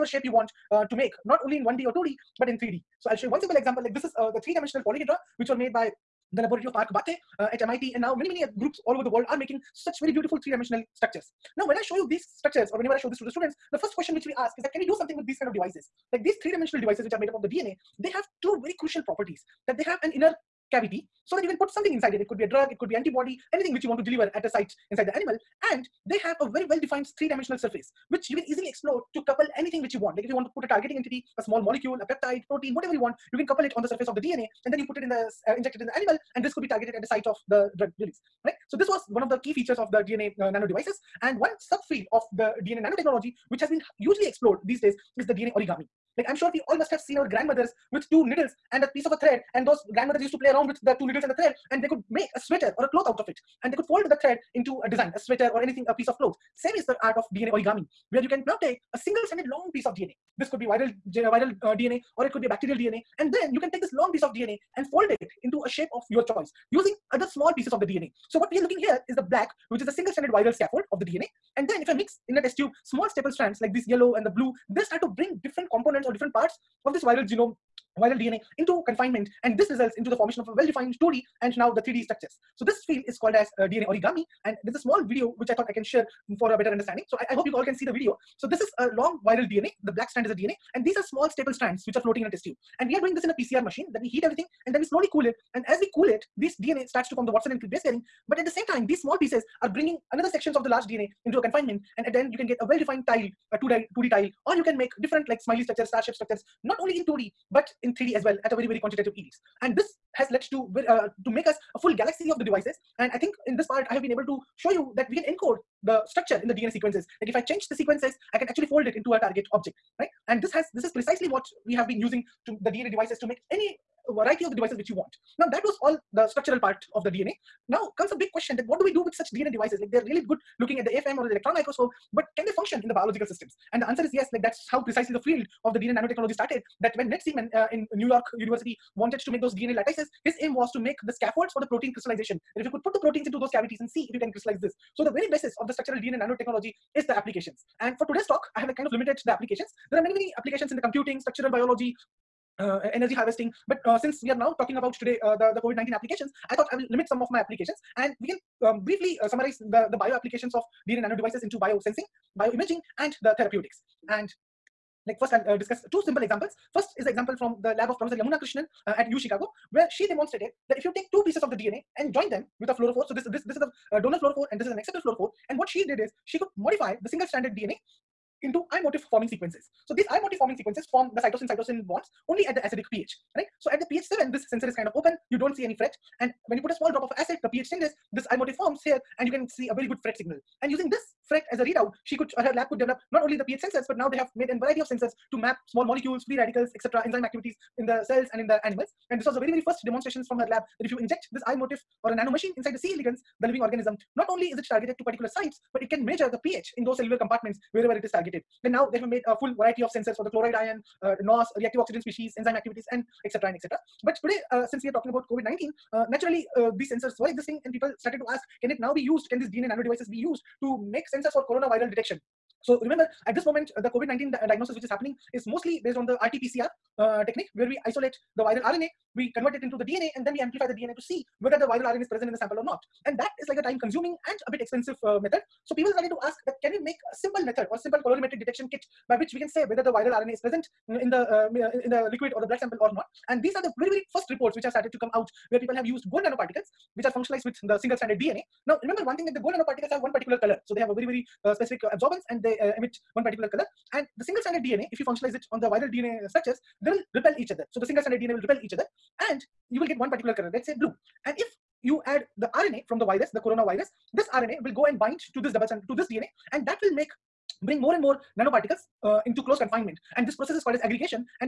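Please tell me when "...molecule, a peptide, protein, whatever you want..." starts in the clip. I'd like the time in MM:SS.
00:31.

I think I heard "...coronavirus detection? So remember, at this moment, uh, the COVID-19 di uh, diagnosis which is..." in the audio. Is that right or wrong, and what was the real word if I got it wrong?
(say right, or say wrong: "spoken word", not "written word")
right.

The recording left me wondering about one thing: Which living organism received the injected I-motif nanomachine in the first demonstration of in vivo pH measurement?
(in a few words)
C. elegans.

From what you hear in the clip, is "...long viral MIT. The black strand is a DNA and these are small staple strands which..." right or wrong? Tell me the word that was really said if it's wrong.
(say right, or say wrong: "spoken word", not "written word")
wrong: "DNA", not "MIT".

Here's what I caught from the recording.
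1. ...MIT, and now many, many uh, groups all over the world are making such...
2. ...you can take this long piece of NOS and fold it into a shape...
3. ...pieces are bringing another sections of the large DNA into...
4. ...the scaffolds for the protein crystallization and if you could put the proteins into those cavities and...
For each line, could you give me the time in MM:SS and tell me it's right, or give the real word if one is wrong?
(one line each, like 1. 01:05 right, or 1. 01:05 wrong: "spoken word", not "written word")
1. 00:07 right
2. 01:03 wrong: "DNA", not "NOS"
3. 01:39 right
4. 02:21 right.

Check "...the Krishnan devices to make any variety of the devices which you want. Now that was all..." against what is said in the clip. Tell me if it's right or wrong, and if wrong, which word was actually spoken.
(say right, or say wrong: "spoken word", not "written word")
wrong: "DNA", not "Krishnan".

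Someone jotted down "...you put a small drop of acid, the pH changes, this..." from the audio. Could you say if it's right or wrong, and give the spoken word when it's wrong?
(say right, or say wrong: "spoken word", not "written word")
right.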